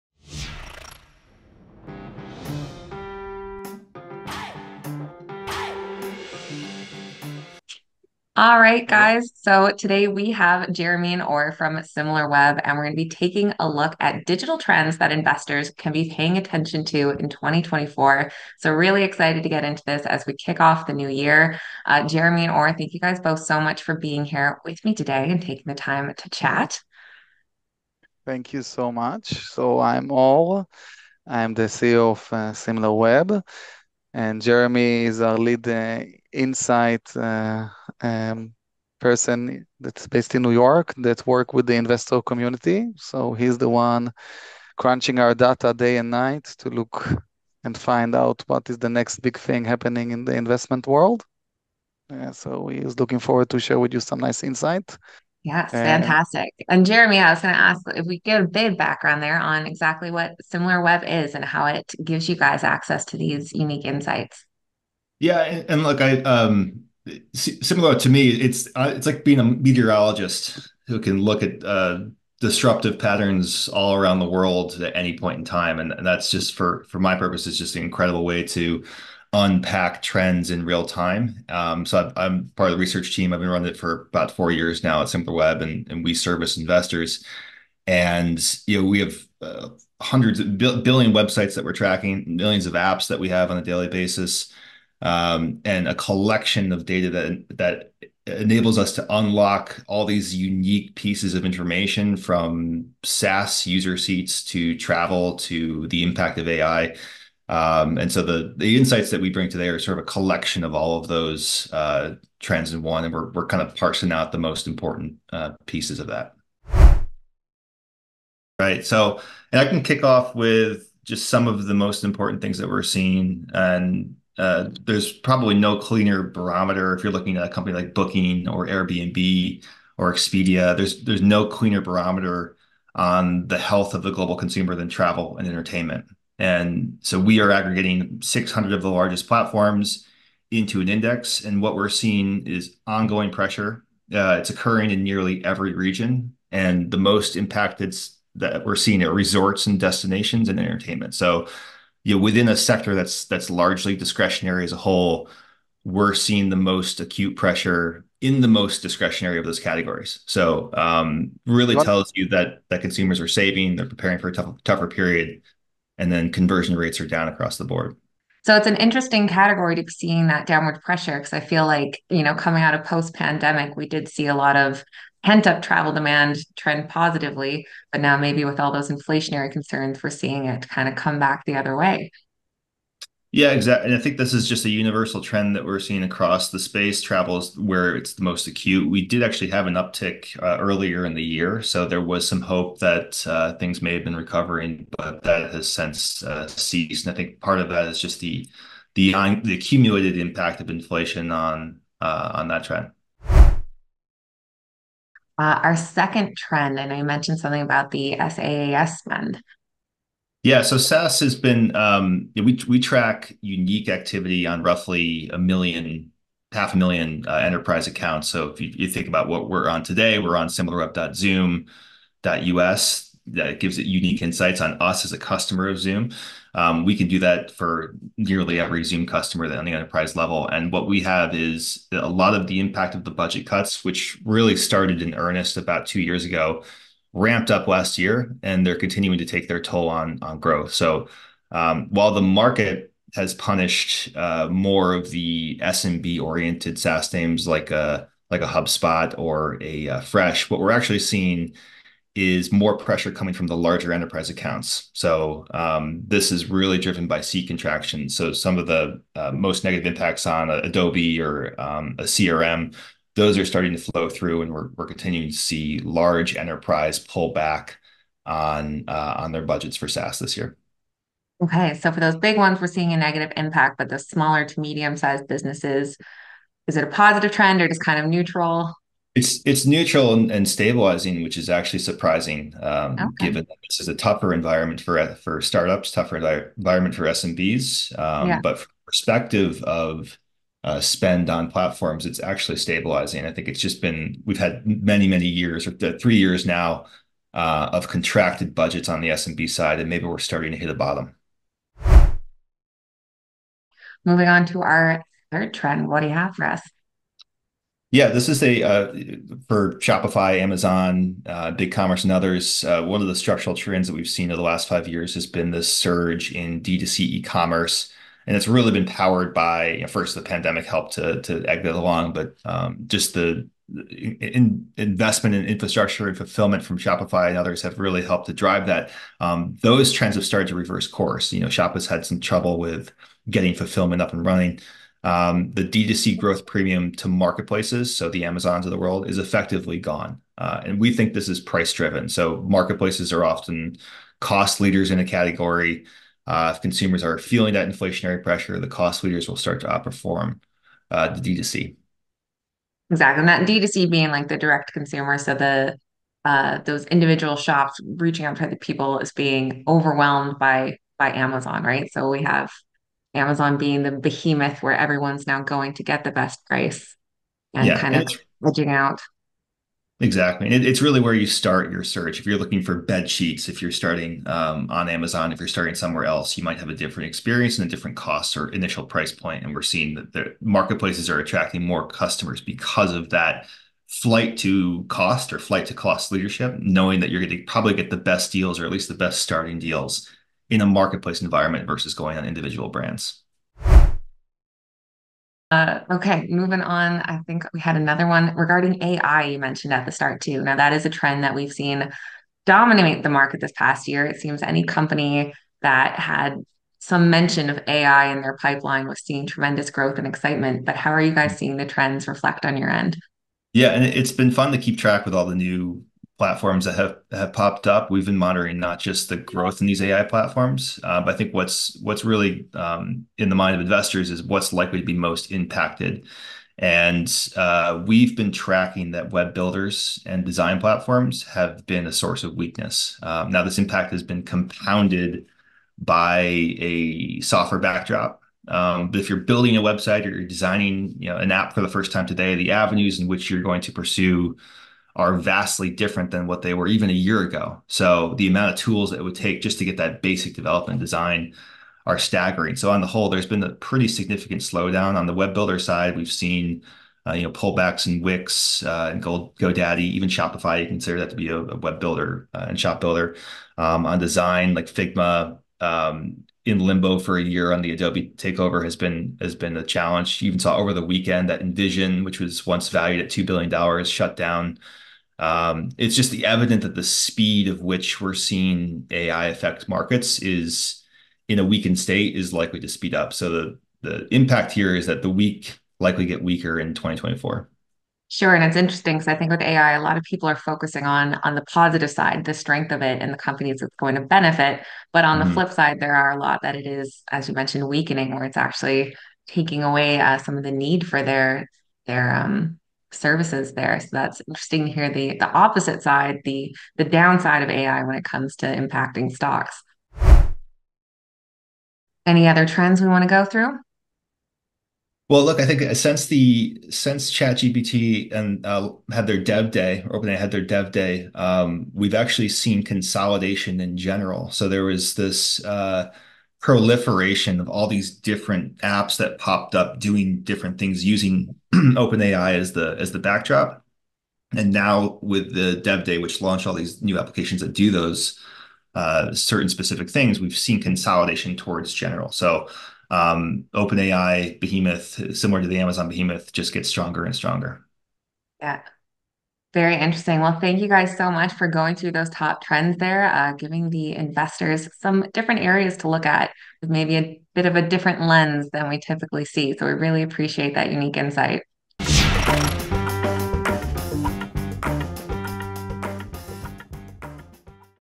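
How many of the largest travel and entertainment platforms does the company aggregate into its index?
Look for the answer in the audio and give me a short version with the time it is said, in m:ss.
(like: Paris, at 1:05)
600, at 2:18.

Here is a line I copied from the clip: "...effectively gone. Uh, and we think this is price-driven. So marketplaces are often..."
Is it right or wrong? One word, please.
right.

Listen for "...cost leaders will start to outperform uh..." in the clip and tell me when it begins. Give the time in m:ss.
5:48.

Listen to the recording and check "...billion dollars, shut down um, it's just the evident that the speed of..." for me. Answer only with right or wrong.
right.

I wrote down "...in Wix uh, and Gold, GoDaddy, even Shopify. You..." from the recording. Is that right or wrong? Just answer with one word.
right.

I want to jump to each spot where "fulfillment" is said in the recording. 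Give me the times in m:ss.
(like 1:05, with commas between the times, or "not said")
5:26, 5:33.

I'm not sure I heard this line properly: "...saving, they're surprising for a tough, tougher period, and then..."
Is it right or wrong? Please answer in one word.
wrong.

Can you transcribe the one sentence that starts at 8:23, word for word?
So that's interesting to hear the the opposite side, the the downside of AI when it comes to impacting stocks.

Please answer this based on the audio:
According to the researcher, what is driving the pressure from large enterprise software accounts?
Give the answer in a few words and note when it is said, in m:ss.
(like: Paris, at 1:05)
seat contraction, at 4:17.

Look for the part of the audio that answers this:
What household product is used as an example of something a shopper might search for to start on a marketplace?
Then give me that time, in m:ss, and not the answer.
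6:12.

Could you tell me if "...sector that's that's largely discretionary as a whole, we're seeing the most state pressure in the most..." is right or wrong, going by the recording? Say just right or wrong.
wrong.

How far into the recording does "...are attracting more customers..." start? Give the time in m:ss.
6:21.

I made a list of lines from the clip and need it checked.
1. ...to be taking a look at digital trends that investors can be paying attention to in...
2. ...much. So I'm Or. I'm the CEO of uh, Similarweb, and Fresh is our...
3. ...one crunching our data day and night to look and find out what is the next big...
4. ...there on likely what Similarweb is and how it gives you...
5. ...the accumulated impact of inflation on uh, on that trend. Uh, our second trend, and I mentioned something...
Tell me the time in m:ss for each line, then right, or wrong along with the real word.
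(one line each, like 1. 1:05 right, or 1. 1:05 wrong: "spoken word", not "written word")
1. 0:12 right
2. 0:28 wrong: "Jeremy", not "Fresh"
3. 0:43 right
4. 0:59 wrong: "exactly", not "likely"
5. 3:19 right.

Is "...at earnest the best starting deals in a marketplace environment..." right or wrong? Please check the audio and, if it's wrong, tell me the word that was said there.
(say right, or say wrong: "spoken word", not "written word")
wrong: "least", not "earnest".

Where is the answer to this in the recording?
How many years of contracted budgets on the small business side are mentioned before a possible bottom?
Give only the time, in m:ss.
4:55.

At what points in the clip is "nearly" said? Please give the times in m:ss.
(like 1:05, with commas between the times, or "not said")
2:25, 3:48.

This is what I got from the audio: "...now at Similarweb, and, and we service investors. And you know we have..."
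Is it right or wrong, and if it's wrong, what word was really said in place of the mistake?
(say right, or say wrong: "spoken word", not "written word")
right.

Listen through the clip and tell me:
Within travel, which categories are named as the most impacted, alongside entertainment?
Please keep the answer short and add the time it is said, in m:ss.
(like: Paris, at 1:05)
resorts and destinations, at 2:29.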